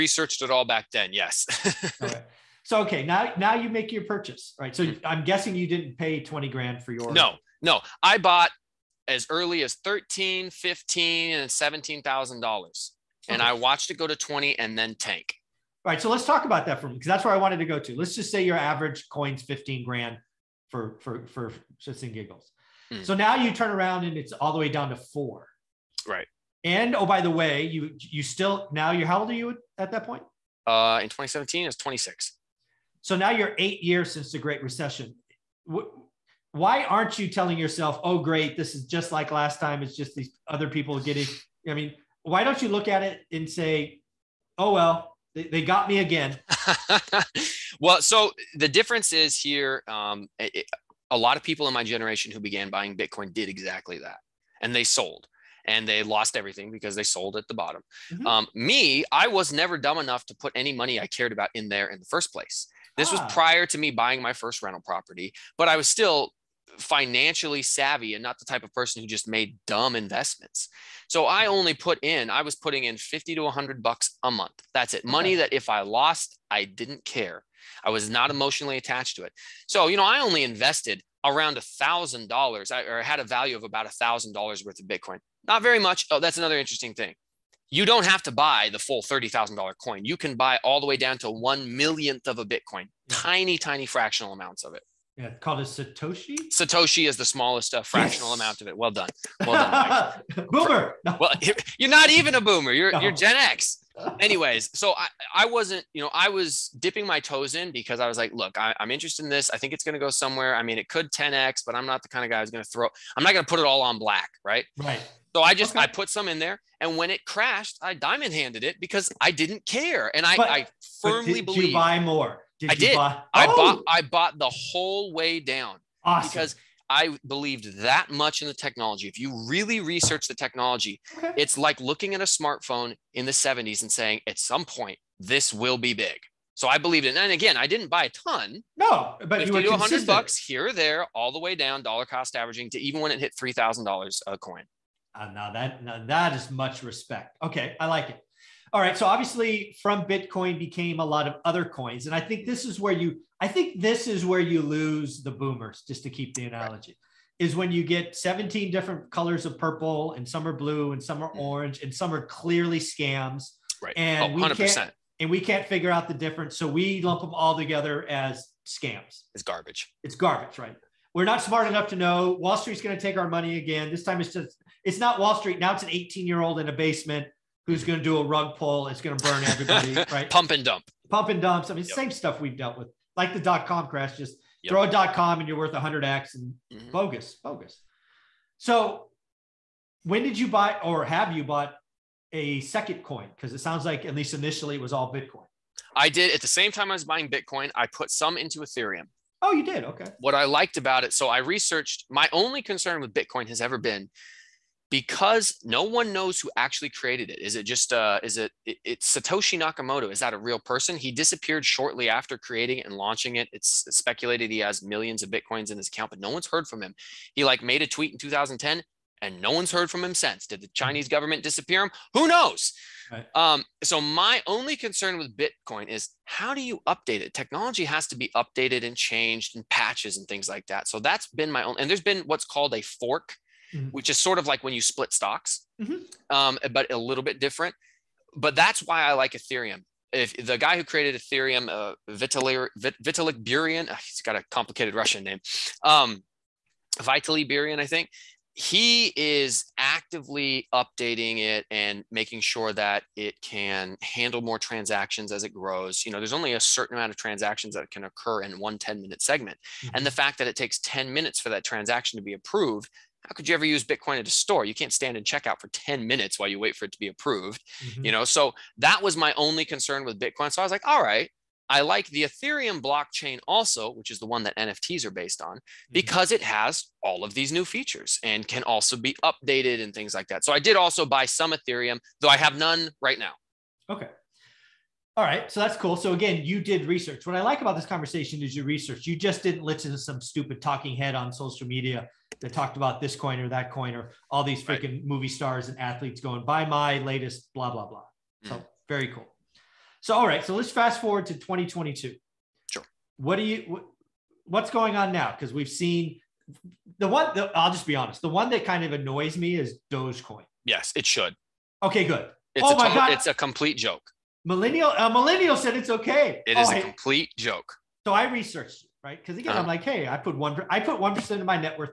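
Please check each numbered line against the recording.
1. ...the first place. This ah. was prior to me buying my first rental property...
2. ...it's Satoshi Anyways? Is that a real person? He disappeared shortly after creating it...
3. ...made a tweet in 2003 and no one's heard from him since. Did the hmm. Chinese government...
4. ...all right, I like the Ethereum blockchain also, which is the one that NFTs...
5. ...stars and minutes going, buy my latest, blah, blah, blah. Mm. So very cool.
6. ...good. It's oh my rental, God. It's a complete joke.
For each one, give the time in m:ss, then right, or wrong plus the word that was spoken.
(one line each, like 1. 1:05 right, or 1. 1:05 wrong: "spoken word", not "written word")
1. 1:01 right
2. 3:28 wrong: "Nakamoto", not "Anyways"
3. 3:37 wrong: "2010", not "2003"
4. 4:30 right
5. 4:55 wrong: "athletes", not "minutes"
6. 5:12 wrong: "total", not "rental".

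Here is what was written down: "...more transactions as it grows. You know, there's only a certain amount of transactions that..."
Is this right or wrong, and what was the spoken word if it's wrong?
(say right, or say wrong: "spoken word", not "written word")
right.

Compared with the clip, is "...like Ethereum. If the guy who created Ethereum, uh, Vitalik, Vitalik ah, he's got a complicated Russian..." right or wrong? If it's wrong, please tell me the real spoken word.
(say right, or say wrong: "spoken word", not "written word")
right.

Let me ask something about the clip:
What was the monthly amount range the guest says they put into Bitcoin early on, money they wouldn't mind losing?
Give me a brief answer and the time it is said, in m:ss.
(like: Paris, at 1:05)
50 to 100 bucks, at 1:12.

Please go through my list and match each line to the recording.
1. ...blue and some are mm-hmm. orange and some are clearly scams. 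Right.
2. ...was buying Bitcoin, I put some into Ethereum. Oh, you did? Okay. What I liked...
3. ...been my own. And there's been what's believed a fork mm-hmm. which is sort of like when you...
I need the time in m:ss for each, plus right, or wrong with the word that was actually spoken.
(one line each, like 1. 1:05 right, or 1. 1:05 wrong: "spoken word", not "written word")
1. 2:40 right
2. 3:16 right
3. 3:51 wrong: "called", not "believed".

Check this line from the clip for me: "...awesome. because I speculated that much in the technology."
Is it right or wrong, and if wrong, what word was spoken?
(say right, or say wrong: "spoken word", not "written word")
wrong: "believed", not "speculated".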